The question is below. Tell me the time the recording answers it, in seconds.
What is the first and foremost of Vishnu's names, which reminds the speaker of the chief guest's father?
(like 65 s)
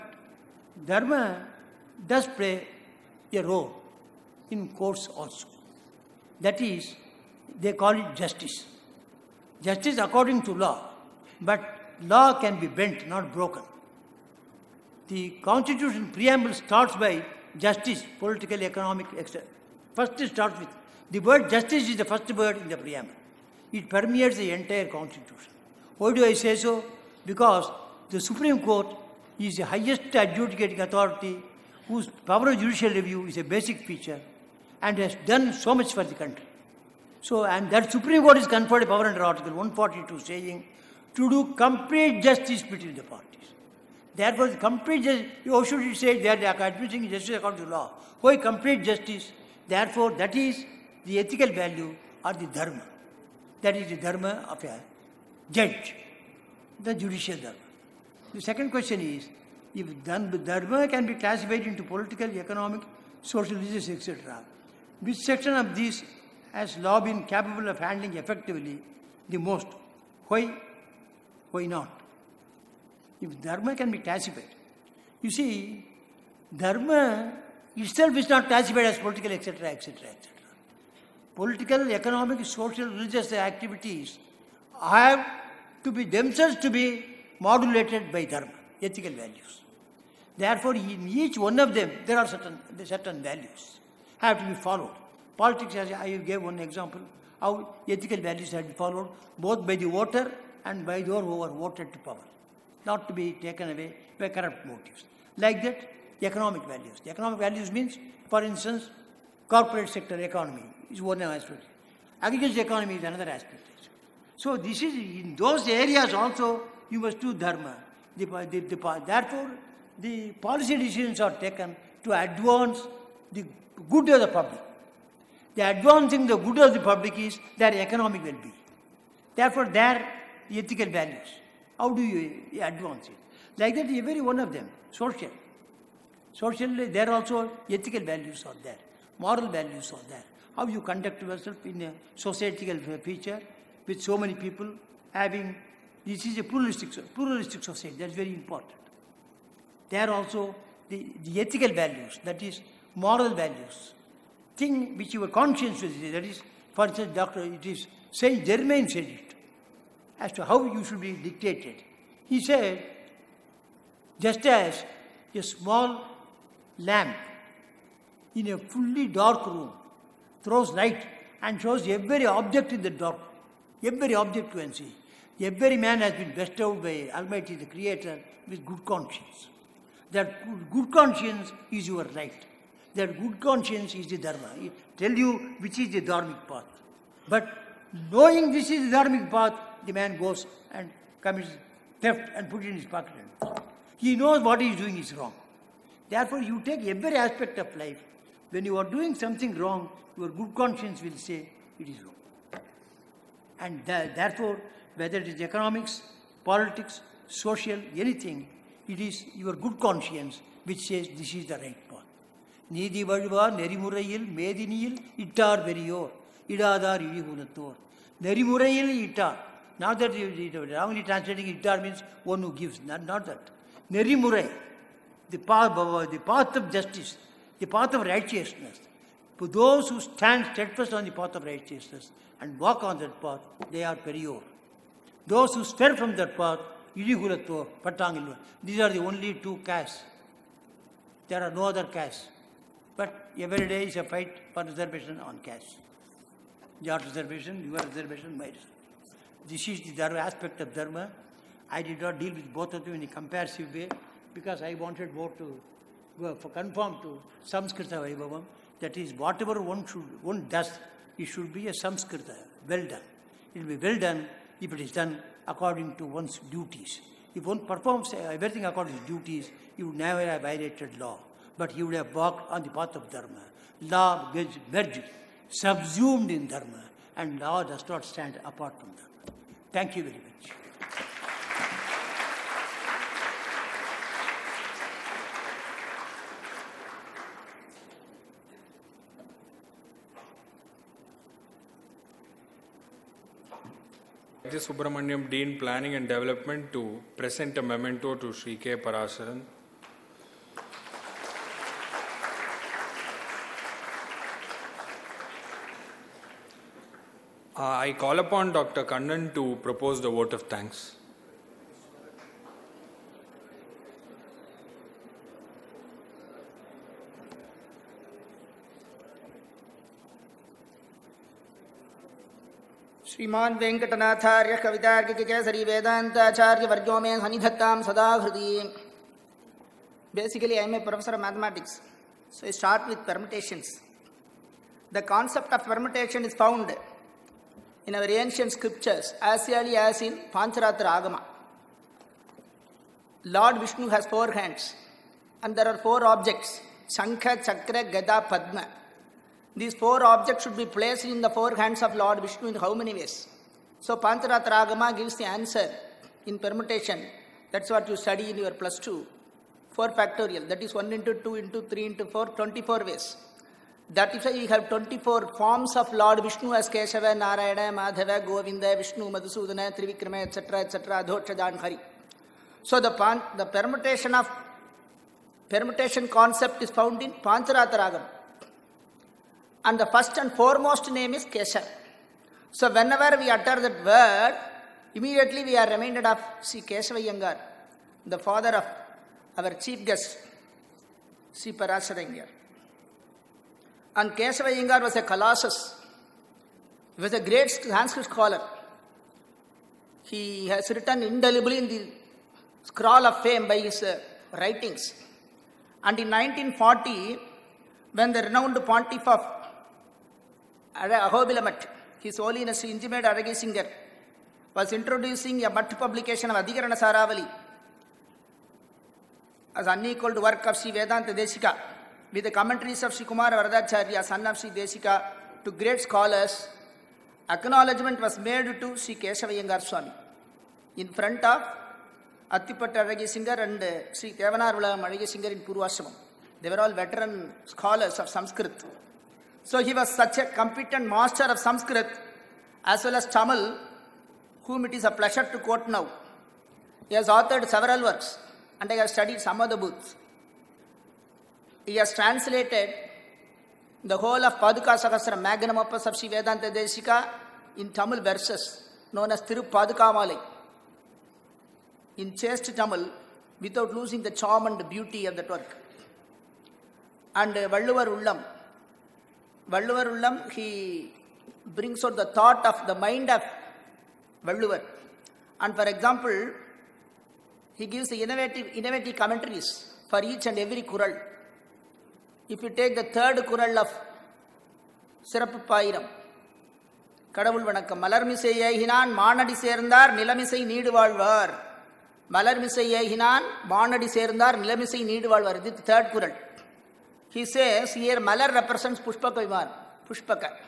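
381 s.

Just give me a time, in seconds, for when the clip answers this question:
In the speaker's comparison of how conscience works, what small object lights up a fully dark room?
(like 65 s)
165 s.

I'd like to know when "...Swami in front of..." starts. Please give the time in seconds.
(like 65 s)
429 s.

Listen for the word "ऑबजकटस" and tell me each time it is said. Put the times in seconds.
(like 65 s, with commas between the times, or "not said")
346 s.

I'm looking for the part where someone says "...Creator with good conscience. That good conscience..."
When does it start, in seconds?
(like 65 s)
177 s.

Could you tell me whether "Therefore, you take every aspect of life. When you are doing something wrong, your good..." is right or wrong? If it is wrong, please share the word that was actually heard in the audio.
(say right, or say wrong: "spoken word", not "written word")
right.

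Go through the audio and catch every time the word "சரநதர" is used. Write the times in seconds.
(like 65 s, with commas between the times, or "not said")
489 s, 493 s.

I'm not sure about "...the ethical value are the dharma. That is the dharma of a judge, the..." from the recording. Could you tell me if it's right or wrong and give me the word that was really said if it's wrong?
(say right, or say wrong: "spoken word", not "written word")
right.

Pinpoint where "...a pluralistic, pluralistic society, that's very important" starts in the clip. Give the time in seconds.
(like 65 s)
146 s.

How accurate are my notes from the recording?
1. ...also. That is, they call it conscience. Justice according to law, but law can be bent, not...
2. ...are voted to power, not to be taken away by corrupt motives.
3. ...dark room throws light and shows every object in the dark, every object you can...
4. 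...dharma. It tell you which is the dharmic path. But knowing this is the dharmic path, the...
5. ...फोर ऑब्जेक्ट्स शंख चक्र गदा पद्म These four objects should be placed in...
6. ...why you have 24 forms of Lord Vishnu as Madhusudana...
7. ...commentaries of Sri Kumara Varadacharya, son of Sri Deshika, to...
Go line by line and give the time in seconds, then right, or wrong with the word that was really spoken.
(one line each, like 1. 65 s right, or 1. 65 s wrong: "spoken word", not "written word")
1. 5 s wrong: "justice", not "conscience"
2. 101 s right
3. 169 s right
4. 184 s right
5. 345 s right
6. 364 s wrong: "Keshava", not "Madhusudana"
7. 422 s right.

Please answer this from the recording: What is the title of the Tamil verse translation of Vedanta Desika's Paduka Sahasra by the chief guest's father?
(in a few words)
Thiru Padukamalai.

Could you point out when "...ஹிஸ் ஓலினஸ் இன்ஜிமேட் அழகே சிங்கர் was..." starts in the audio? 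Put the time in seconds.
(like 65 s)
412 s.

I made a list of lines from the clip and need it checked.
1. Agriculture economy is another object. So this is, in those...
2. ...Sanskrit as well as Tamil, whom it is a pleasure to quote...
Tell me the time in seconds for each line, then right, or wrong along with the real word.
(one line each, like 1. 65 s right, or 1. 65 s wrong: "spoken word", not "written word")
1. 112 s wrong: "aspect", not "object"
2. 441 s right.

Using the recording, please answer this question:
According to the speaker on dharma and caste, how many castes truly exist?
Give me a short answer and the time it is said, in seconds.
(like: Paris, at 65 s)
2, at 239 s.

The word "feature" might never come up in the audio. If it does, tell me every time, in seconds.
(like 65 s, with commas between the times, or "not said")
33 s, 142 s.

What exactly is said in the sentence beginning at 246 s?
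Your reservation, your reservation, my reservation.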